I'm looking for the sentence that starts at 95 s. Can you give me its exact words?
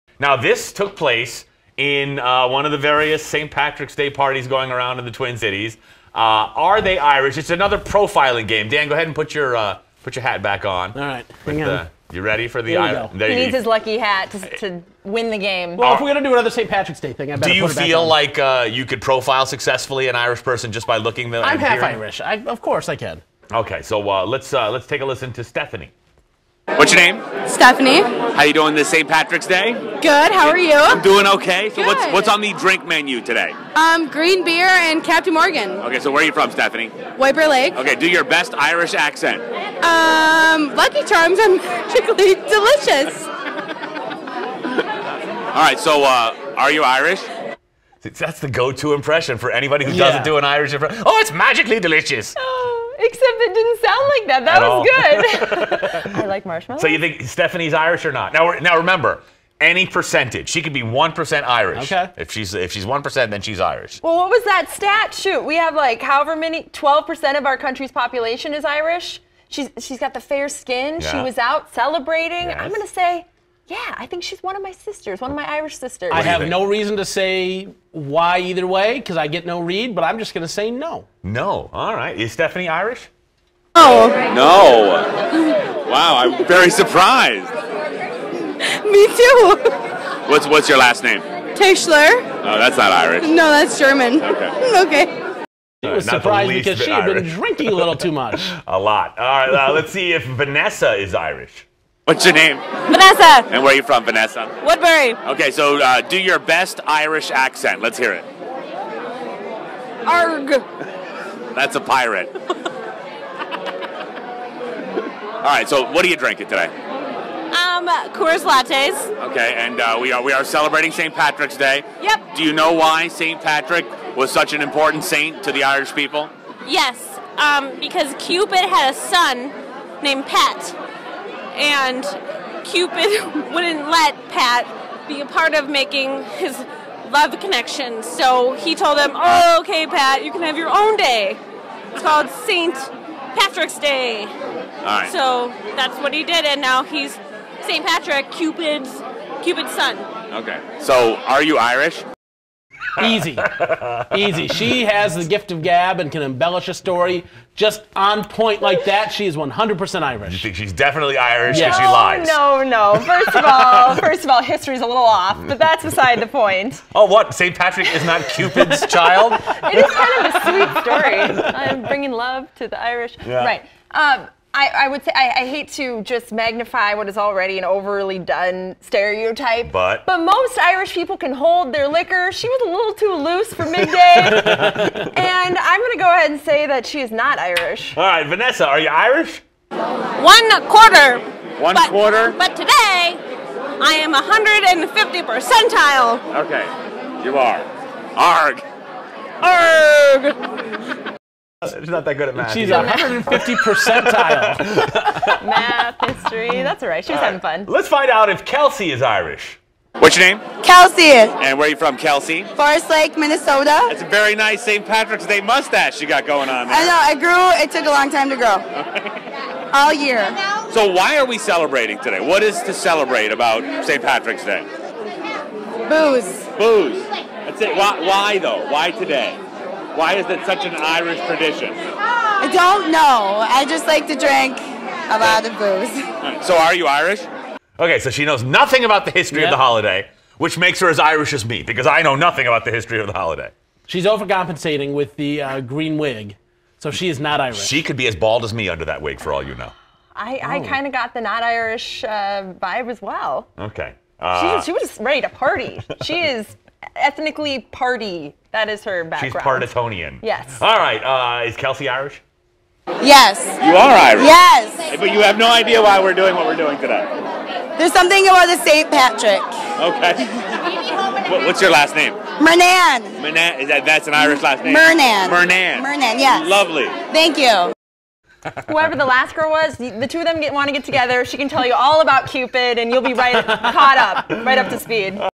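He was uh, surprised because she had Irish.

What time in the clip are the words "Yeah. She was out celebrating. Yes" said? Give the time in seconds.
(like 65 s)
71 s.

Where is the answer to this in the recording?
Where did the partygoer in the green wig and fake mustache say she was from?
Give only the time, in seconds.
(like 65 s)
212 s.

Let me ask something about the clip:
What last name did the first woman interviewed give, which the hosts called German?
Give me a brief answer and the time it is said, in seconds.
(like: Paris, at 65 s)
Tischler, at 91 s.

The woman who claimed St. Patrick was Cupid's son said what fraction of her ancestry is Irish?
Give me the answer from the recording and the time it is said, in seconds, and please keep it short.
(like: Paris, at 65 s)
One quarter, at 189 s.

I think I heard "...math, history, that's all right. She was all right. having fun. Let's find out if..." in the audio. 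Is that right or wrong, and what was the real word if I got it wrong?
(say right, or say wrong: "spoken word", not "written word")
right.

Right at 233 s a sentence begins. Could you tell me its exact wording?
I just like to drink a lot of booze.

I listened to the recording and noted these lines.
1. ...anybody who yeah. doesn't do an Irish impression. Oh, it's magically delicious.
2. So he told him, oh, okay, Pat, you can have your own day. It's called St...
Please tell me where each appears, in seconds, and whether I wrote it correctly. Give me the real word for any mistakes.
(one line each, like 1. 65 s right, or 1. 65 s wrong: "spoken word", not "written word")
1. 49 s right
2. 138 s right.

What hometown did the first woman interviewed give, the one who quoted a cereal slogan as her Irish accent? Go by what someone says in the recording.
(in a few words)
White Bear Lake.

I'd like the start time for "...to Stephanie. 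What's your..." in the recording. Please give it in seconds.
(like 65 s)
25 s.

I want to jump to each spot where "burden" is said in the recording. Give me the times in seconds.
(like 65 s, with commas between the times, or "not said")
not said.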